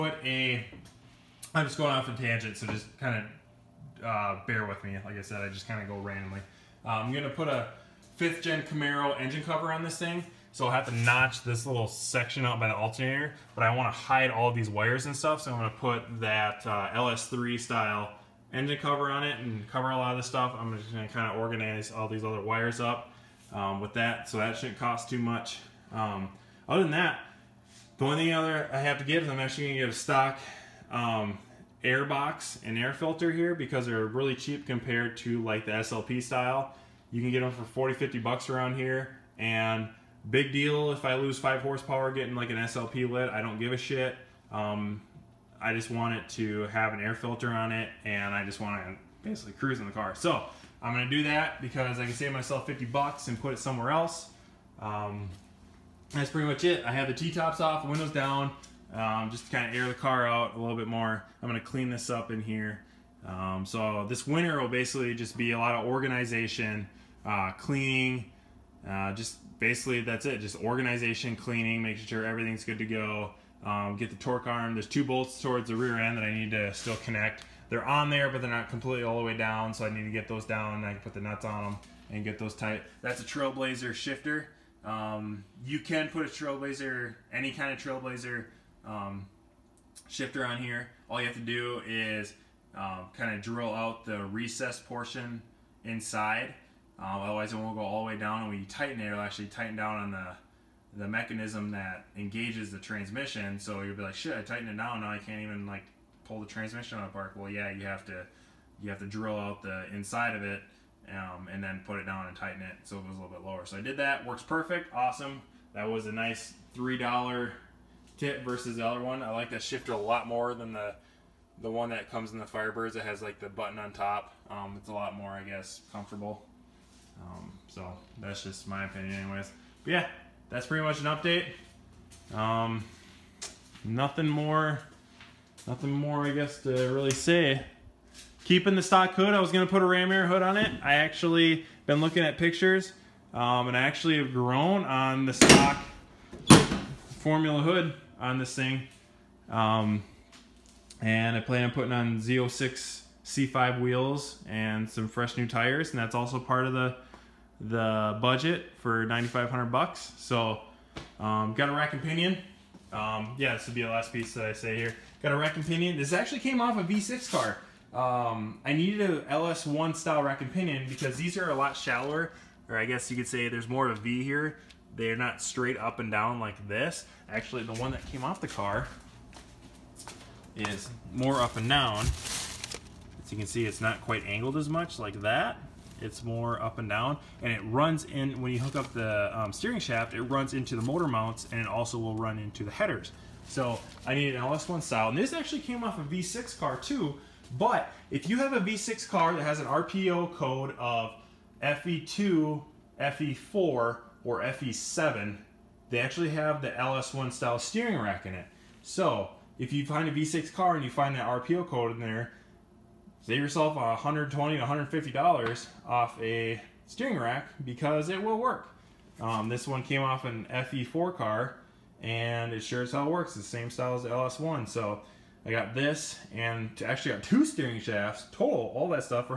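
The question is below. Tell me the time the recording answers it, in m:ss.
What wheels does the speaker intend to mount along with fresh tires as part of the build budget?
2:32.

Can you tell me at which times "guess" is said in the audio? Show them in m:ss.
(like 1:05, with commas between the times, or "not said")
2:05, 2:16, 2:52.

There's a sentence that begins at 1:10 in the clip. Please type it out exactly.
Just organization, cleaning, making sure everything's good to go.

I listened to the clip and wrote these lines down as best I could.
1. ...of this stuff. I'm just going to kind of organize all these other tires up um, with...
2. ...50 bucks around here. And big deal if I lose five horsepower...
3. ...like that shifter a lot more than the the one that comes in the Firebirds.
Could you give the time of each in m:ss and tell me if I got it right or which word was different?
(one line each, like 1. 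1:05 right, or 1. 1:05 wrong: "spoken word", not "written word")
1. 0:20 wrong: "wires", not "tires"
2. 0:37 right
3. 1:59 right.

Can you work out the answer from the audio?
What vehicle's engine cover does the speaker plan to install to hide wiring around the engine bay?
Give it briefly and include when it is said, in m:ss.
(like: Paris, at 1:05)
Fifth gen Camaro, at 0:08.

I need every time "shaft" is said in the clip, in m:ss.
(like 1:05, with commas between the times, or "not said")
3:09, 3:47.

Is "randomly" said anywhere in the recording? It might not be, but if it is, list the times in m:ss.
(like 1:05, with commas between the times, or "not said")
0:05.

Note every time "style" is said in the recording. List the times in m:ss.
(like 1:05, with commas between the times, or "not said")
0:17, 0:36, 2:49, 3:14, 3:27, 3:43.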